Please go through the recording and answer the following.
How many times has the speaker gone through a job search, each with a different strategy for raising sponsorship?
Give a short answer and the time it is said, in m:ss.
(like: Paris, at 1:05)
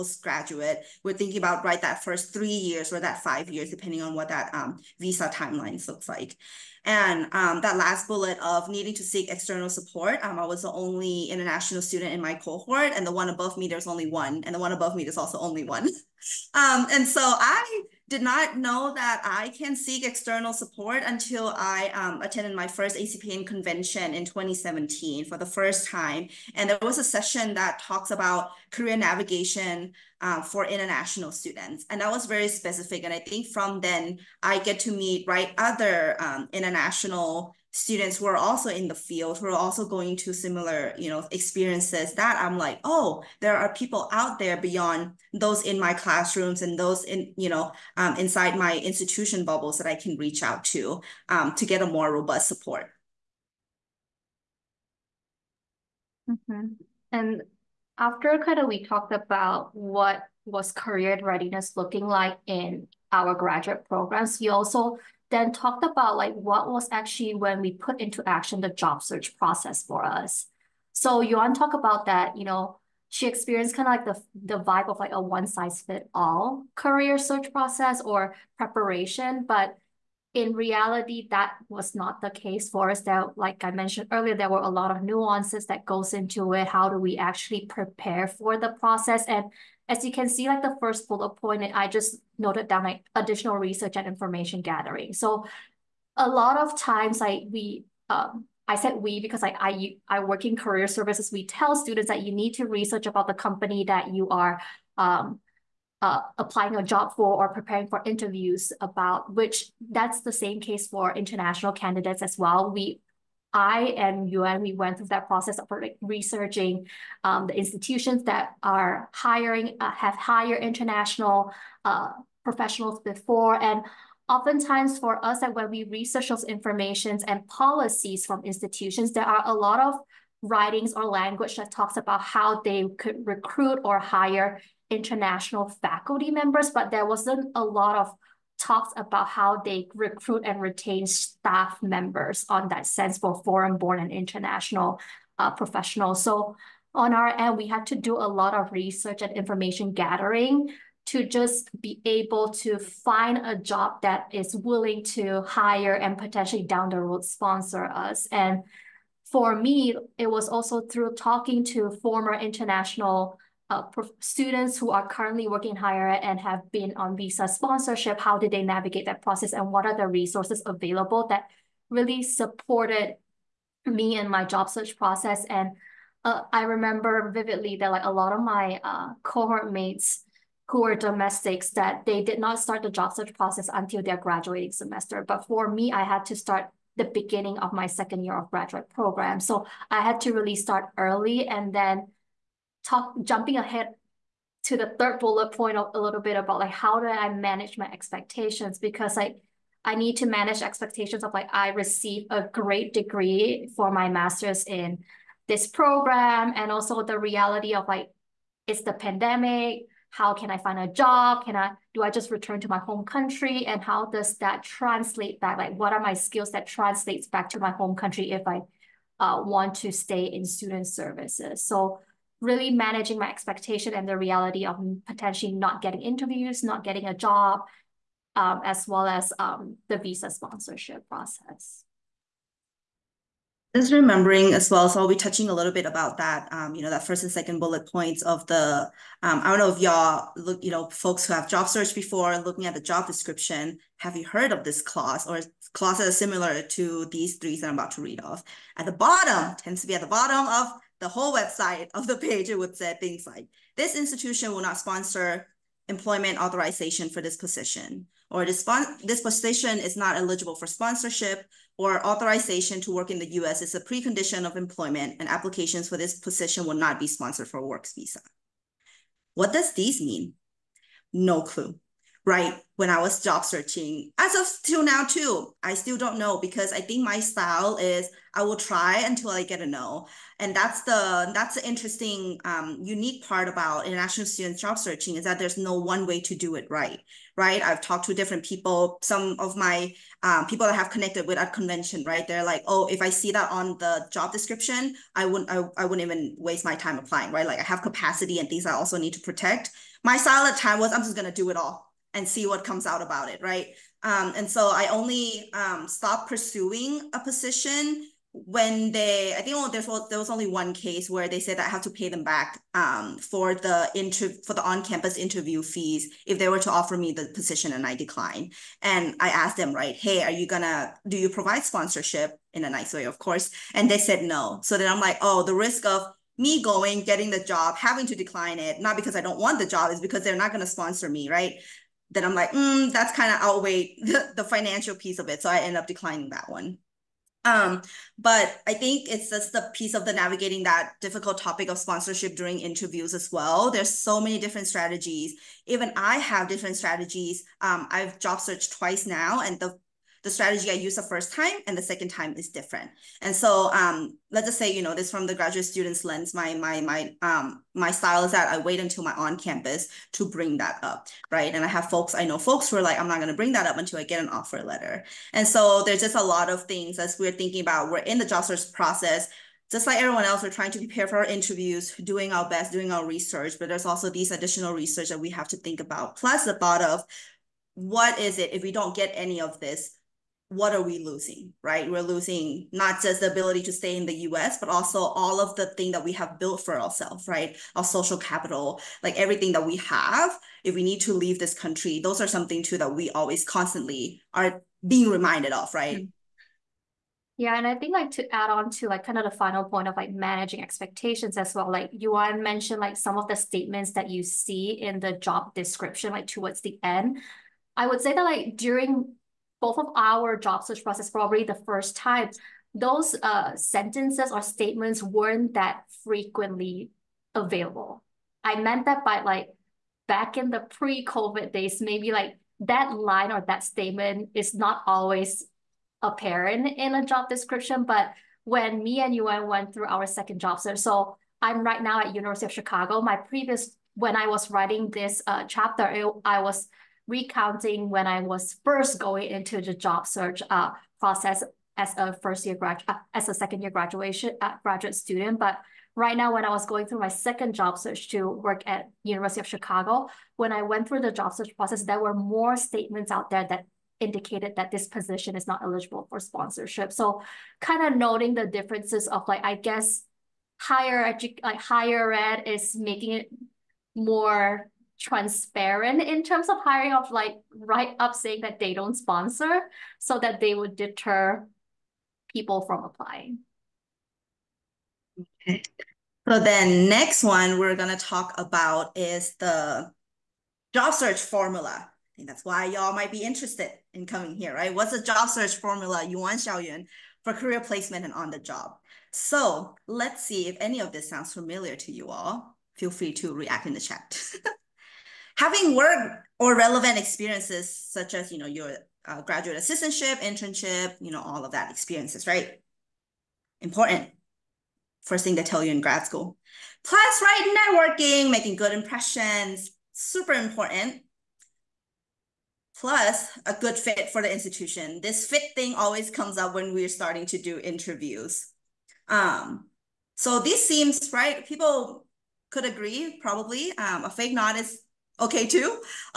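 twice, at 5:48.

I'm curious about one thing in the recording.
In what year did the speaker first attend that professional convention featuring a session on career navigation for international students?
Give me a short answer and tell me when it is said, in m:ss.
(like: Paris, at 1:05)
2017, at 0:24.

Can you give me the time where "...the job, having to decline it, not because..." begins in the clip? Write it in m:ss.
5:27.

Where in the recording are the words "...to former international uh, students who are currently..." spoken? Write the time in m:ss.
2:41.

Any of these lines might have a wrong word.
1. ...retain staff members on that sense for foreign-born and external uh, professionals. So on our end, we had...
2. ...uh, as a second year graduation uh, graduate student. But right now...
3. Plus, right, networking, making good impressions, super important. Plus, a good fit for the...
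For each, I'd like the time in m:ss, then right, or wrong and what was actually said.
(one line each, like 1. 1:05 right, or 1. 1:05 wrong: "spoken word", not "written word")
1. 2:20 wrong: "international", not "external"
2. 7:22 right
3. 8:26 right.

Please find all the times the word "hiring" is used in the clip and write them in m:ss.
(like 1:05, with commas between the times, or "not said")
1:59, 7:46.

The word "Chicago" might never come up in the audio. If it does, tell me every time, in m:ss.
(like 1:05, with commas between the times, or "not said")
7:12, 7:29.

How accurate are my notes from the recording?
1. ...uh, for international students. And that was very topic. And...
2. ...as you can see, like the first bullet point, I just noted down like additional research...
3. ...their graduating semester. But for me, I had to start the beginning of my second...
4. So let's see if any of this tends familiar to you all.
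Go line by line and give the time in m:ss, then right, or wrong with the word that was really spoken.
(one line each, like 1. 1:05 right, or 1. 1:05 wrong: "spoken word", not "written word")
1. 0:30 wrong: "specific", not "topic"
2. 1:29 right
3. 3:04 right
4. 8:09 wrong: "sounds", not "tends".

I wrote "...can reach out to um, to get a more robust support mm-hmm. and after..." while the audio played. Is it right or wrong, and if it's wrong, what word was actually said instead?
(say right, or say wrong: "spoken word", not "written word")
right.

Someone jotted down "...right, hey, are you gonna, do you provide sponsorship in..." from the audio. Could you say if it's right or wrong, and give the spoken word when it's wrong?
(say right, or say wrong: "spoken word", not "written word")
right.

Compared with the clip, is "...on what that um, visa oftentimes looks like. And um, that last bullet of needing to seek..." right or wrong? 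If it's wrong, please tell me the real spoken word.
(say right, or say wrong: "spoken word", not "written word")
wrong: "timelines", not "oftentimes".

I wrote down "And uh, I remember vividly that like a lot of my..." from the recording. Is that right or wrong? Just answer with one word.
right.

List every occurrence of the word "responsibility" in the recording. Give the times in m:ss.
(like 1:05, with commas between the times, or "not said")
not said.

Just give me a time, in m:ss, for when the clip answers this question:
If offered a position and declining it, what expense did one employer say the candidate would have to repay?
5:14.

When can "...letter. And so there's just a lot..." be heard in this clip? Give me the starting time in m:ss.
6:04.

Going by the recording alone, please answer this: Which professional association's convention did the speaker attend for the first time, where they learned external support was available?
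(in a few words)
ACPA.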